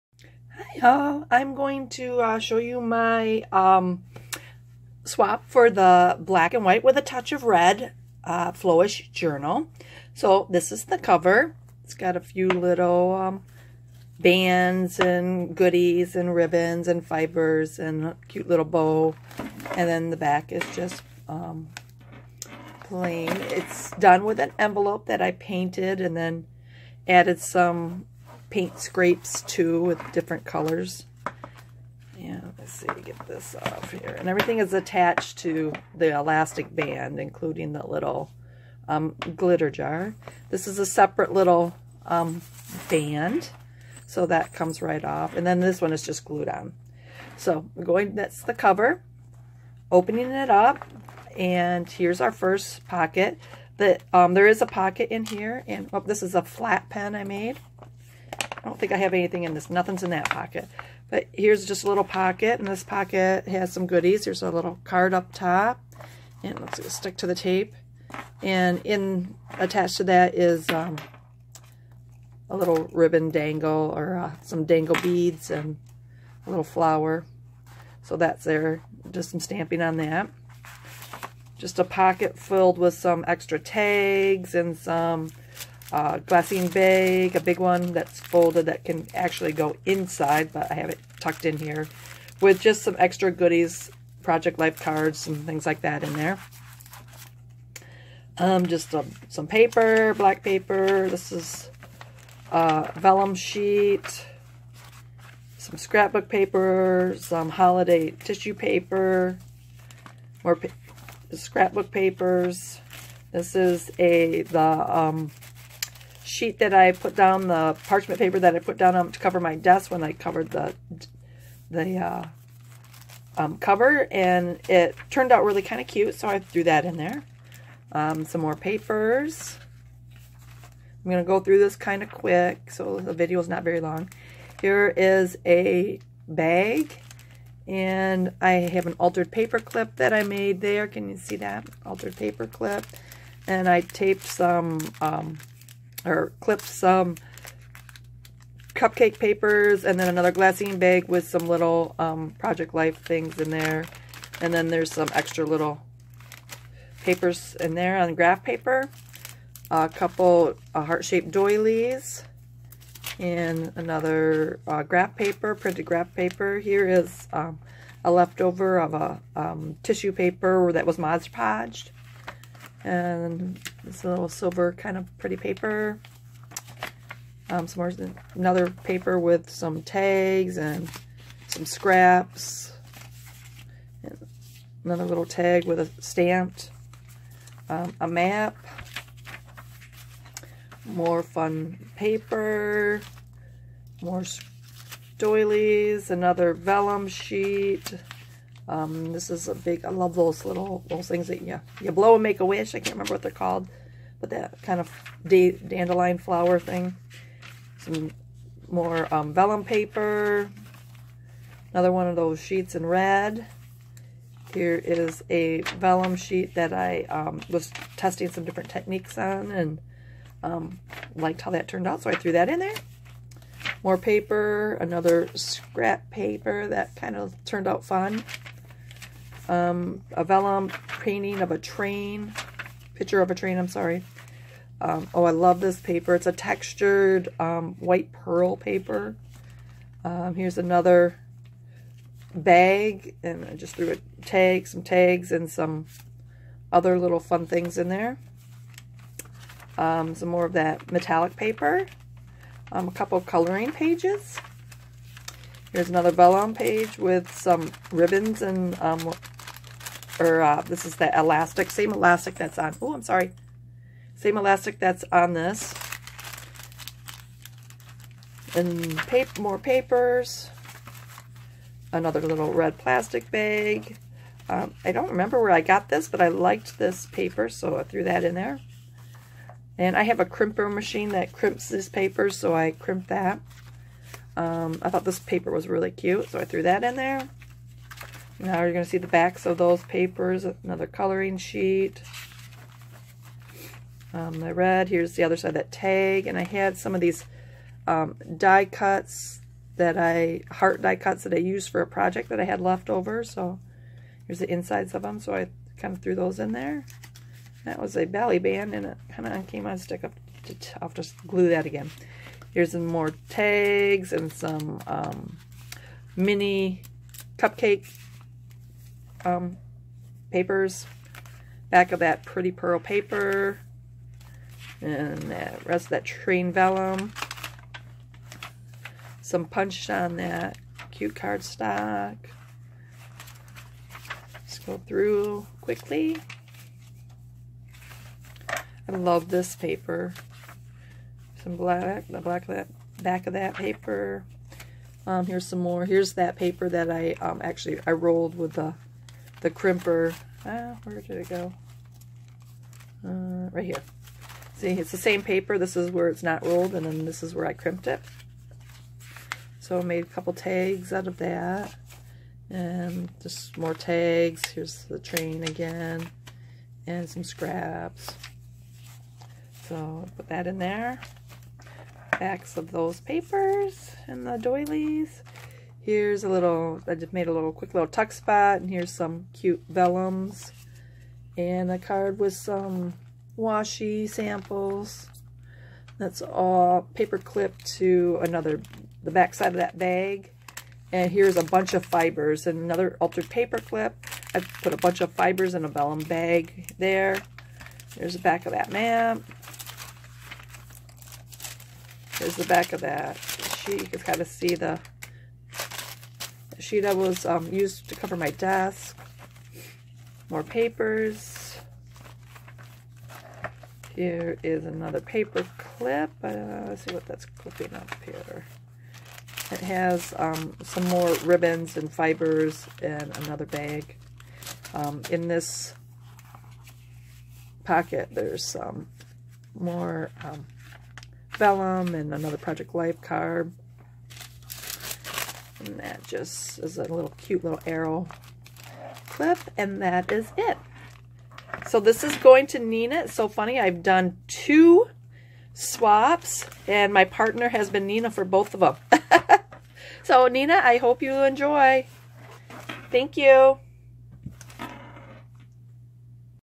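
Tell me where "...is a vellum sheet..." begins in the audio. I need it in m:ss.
3:34.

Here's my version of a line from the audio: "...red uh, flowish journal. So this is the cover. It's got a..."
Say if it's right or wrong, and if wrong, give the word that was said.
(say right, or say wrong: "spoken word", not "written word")
right.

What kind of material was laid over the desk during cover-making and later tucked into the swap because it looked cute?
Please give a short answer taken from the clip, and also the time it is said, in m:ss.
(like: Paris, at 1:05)
parchment paper, at 1:57.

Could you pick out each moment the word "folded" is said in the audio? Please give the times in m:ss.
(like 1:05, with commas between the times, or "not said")
1:28.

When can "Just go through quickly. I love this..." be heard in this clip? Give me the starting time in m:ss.
5:34.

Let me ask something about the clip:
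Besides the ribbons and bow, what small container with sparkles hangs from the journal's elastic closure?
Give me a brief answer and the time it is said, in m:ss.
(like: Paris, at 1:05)
glitter jar, at 0:39.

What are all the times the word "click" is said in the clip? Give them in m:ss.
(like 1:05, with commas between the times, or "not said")
not said.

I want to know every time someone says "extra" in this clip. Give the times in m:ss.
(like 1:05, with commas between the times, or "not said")
1:23, 1:32, 2:35.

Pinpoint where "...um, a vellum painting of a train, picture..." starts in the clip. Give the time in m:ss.
3:49.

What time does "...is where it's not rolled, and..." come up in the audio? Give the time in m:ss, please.
5:55.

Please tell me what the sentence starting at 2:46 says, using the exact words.
Here is um, a leftover of a um, tissue paper that was Mod Podged.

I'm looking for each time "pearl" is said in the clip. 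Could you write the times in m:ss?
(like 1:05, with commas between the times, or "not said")
3:58, 5:22.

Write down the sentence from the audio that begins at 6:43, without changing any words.
You can kind of see the sheet I was um, used to cover my desk.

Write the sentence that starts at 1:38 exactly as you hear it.
Um, just a, some paper, black paper.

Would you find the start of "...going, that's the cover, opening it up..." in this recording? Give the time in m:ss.
0:47.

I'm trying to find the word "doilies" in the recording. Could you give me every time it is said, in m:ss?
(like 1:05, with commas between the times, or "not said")
2:41, 3:15, 6:14.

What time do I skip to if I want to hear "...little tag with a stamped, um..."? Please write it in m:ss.
3:05.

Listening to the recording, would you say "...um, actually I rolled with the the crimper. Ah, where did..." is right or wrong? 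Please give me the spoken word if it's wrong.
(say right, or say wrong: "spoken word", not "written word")
right.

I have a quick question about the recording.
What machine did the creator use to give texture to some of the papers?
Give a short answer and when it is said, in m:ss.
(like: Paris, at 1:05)
a crimper, at 4:40.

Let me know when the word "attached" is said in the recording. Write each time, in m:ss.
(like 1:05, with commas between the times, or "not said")
0:34, 1:09.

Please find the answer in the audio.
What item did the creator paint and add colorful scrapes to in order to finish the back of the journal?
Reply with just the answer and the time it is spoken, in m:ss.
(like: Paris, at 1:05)
an envelope, at 0:24.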